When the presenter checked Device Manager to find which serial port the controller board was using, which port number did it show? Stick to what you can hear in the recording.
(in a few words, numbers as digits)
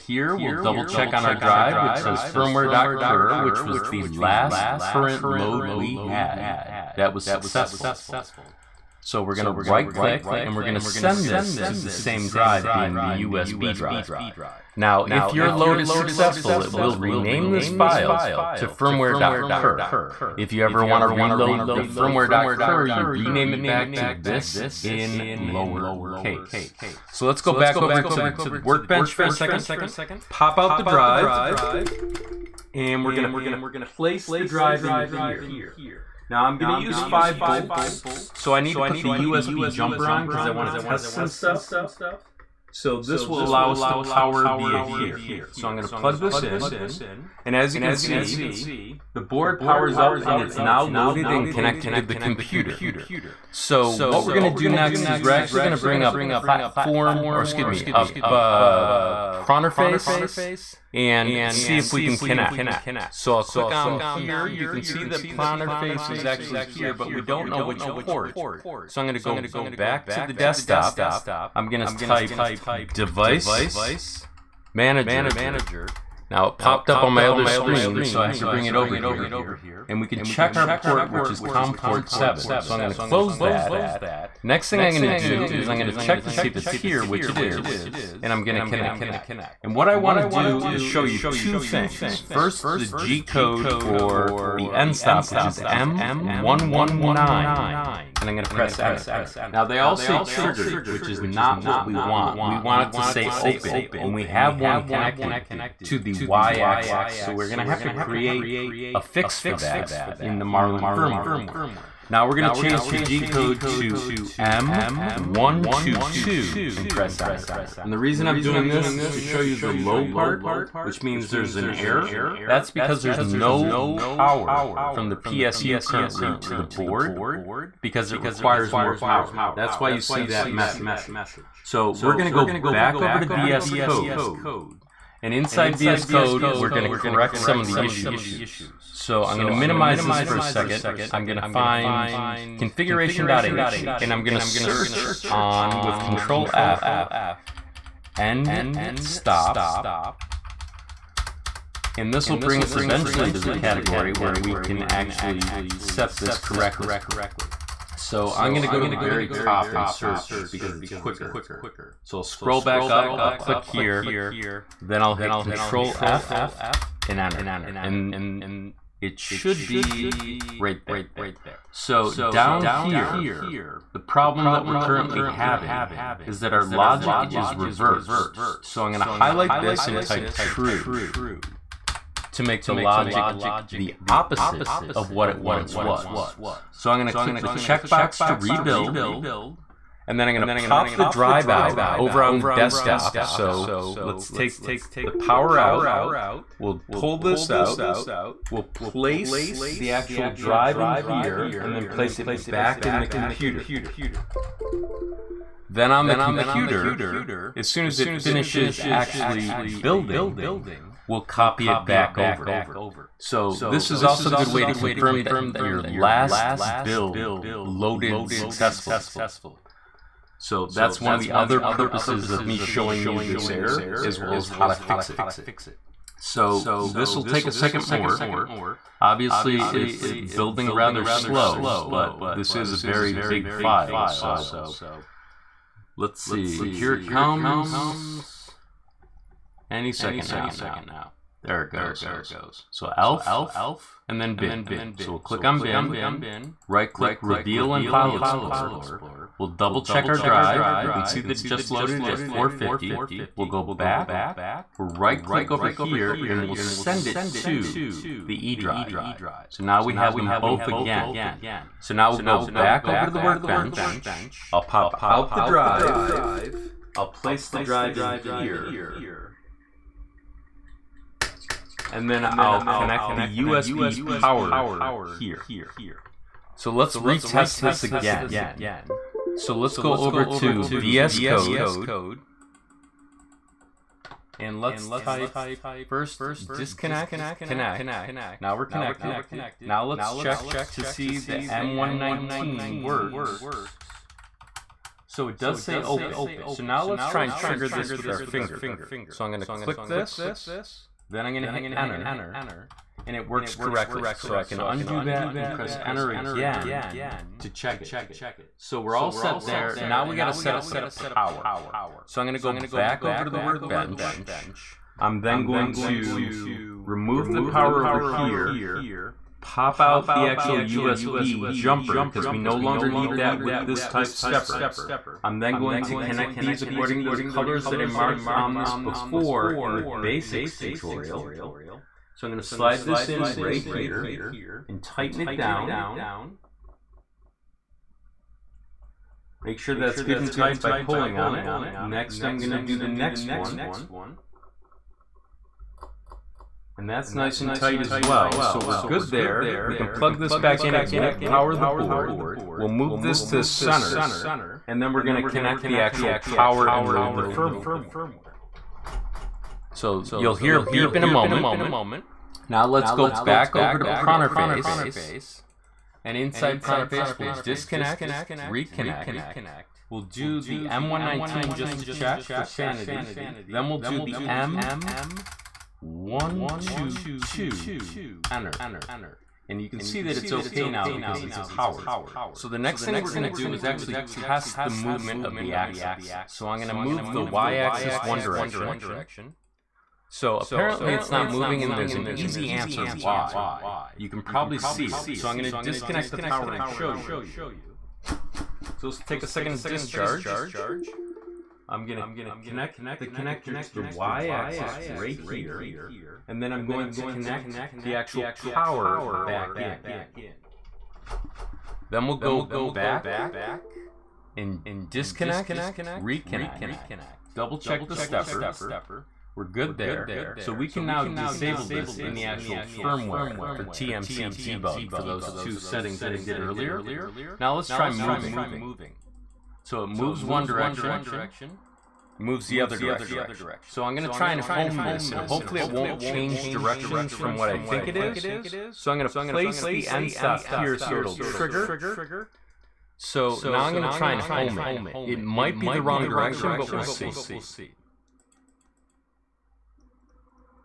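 COM port 7.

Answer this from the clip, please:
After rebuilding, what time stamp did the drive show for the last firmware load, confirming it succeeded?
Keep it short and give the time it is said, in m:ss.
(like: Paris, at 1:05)
450, at 4:12.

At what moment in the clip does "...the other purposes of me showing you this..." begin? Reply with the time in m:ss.
3:41.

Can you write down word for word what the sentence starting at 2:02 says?
That's because there's no power from the PSU currently to the board because it requires more power.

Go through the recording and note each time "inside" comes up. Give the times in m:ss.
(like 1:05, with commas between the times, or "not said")
2:15, 6:06.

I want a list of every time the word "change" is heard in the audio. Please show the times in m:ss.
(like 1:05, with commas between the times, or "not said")
1:52, 7:15.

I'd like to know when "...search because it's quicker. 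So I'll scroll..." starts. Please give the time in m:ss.
2:39.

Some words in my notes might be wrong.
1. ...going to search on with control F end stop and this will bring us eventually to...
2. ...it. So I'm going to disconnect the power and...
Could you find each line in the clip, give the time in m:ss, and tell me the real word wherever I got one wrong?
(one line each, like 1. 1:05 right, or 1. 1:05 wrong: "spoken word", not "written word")
1. 2:24 right
2. 6:34 right.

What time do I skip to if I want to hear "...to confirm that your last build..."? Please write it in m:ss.
3:34.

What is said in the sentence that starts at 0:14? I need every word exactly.
Now, if your load is successful, it will rename this file to firmware.cur.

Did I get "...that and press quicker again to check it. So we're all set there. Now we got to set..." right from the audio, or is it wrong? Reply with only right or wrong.
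wrong.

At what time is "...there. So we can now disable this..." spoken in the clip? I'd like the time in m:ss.
6:59.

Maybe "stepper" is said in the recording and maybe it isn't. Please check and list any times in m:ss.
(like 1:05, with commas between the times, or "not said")
5:24, 6:57.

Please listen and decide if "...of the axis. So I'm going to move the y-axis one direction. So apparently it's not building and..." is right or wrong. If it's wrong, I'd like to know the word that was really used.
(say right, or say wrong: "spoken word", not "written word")
wrong: "moving", not "building".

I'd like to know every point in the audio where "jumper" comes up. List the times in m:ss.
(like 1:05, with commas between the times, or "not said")
0:39, 5:21.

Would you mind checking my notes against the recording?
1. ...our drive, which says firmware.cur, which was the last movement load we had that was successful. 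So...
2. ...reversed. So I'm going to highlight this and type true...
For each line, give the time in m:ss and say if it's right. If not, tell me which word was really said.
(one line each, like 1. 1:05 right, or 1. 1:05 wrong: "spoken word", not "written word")
1. 0:01 wrong: "current", not "movement"
2. 2:57 right.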